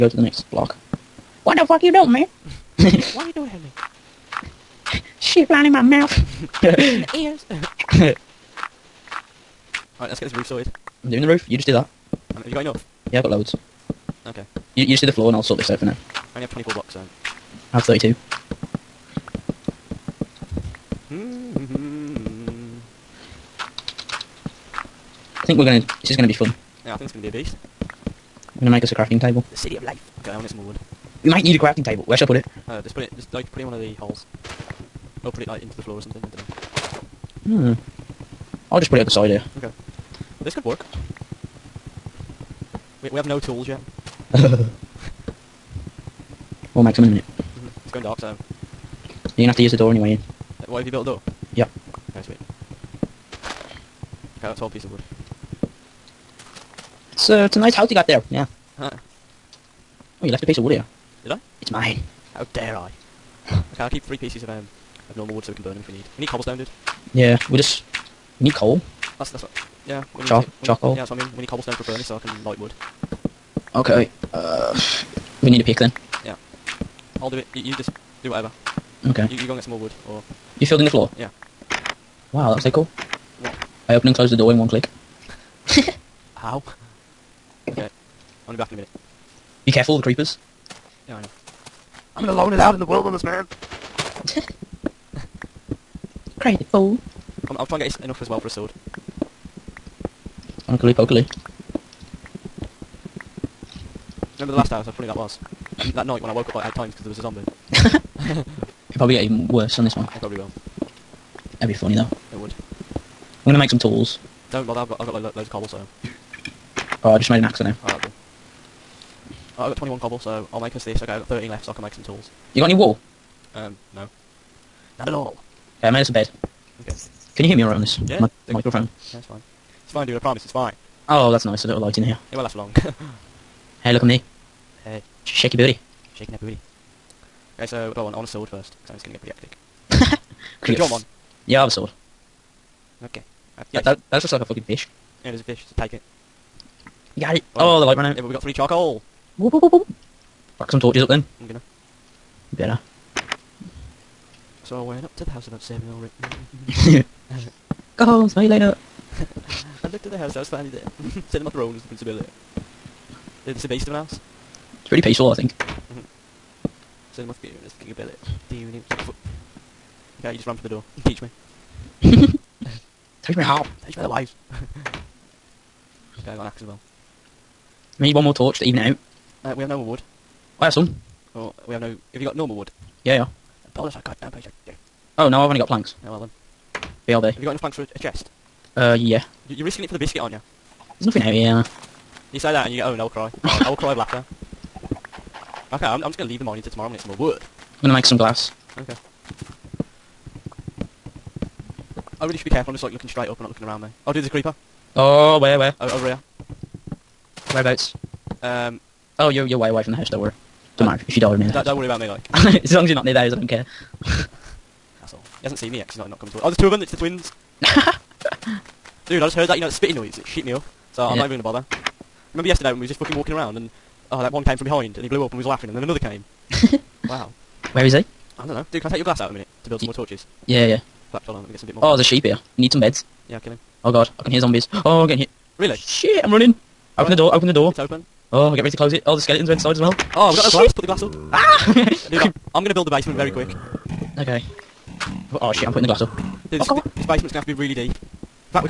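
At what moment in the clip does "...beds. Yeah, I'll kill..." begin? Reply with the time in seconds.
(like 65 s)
232 s.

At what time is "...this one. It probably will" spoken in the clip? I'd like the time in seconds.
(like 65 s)
109 s.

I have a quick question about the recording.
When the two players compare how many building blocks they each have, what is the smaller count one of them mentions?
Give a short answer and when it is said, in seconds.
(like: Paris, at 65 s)
24, at 16 s.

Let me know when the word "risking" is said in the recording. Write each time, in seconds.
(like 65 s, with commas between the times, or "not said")
189 s.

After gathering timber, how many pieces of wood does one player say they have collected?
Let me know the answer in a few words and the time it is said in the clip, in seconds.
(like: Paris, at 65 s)
12, at 54 s.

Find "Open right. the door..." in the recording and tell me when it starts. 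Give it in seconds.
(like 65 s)
236 s.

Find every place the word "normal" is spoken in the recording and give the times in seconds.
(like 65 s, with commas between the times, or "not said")
65 s, 182 s.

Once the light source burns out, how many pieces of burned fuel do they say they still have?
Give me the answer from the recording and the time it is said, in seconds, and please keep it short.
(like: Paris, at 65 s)
3, at 148 s.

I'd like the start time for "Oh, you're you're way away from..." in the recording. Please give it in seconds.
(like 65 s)
209 s.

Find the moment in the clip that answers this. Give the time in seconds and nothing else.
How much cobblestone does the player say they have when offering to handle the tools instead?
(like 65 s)
119 s.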